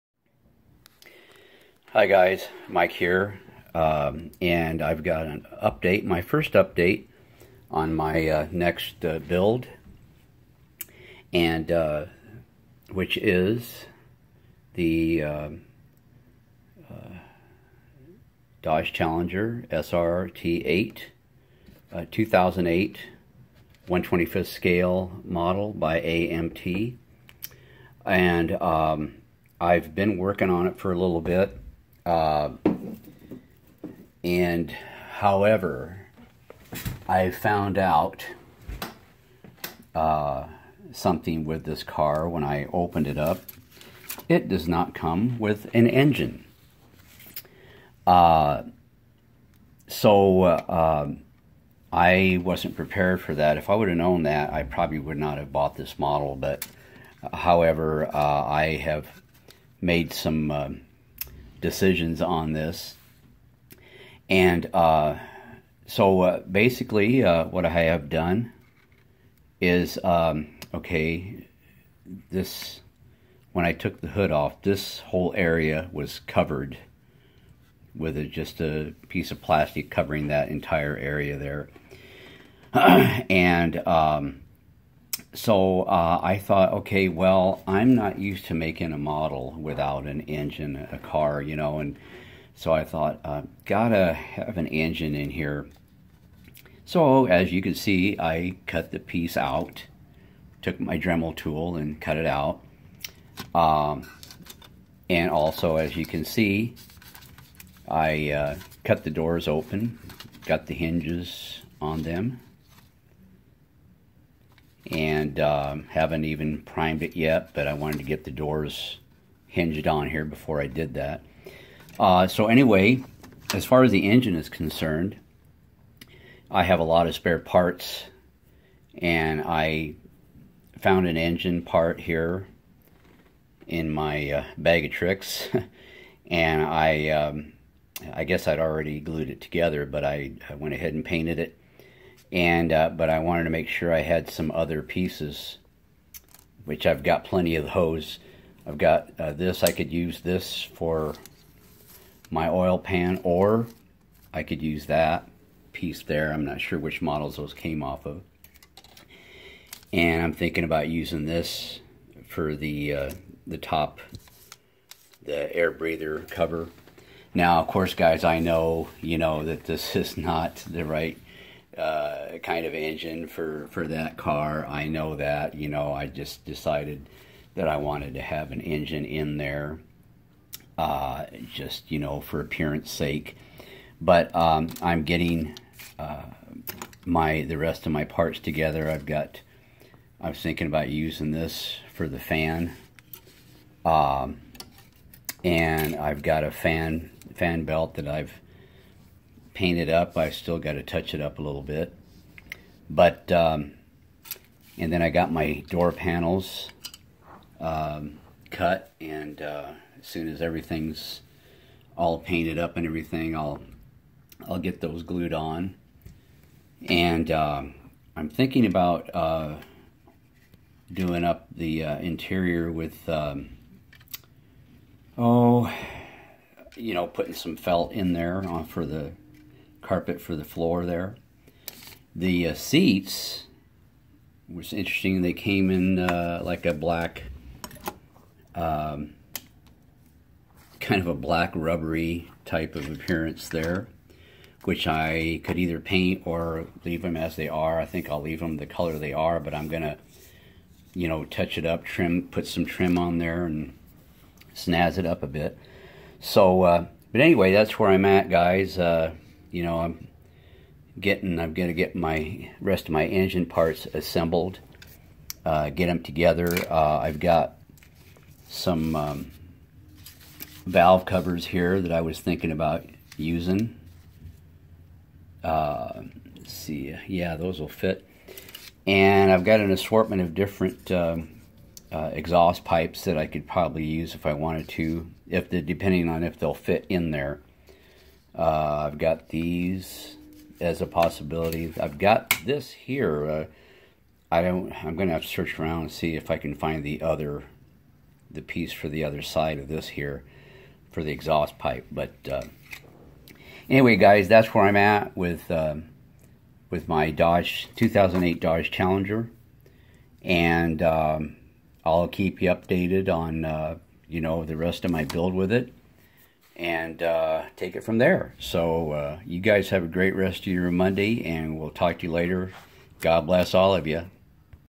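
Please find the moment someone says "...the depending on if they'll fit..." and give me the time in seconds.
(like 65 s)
285 s.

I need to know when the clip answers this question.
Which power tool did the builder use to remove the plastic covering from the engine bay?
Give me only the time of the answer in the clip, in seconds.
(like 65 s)
100 s.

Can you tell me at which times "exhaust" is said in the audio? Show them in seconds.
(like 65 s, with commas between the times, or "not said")
282 s, 301 s.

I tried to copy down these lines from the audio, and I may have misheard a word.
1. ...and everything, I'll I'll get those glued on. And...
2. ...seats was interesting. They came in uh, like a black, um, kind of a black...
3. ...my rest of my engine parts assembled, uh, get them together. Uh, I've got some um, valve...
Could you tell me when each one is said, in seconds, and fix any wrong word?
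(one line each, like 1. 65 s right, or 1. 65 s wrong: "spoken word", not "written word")
1. 212 s right
2. 232 s right
3. 261 s right.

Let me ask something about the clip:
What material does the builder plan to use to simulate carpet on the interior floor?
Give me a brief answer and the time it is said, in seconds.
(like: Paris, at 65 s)
felt, at 227 s.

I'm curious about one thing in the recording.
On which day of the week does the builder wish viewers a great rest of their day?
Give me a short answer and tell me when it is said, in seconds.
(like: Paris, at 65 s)
Monday, at 320 s.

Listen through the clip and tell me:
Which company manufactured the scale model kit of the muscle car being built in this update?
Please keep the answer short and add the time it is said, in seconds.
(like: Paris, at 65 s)
AMT, at 25 s.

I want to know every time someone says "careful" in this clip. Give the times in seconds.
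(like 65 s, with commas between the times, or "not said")
not said.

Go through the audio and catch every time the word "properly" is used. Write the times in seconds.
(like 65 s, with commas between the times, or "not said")
not said.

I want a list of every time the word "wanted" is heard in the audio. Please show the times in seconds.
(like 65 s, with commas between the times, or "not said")
117 s, 143 s, 177 s, 284 s.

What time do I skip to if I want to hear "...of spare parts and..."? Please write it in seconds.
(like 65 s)
127 s.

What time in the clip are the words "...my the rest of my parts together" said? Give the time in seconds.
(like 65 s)
187 s.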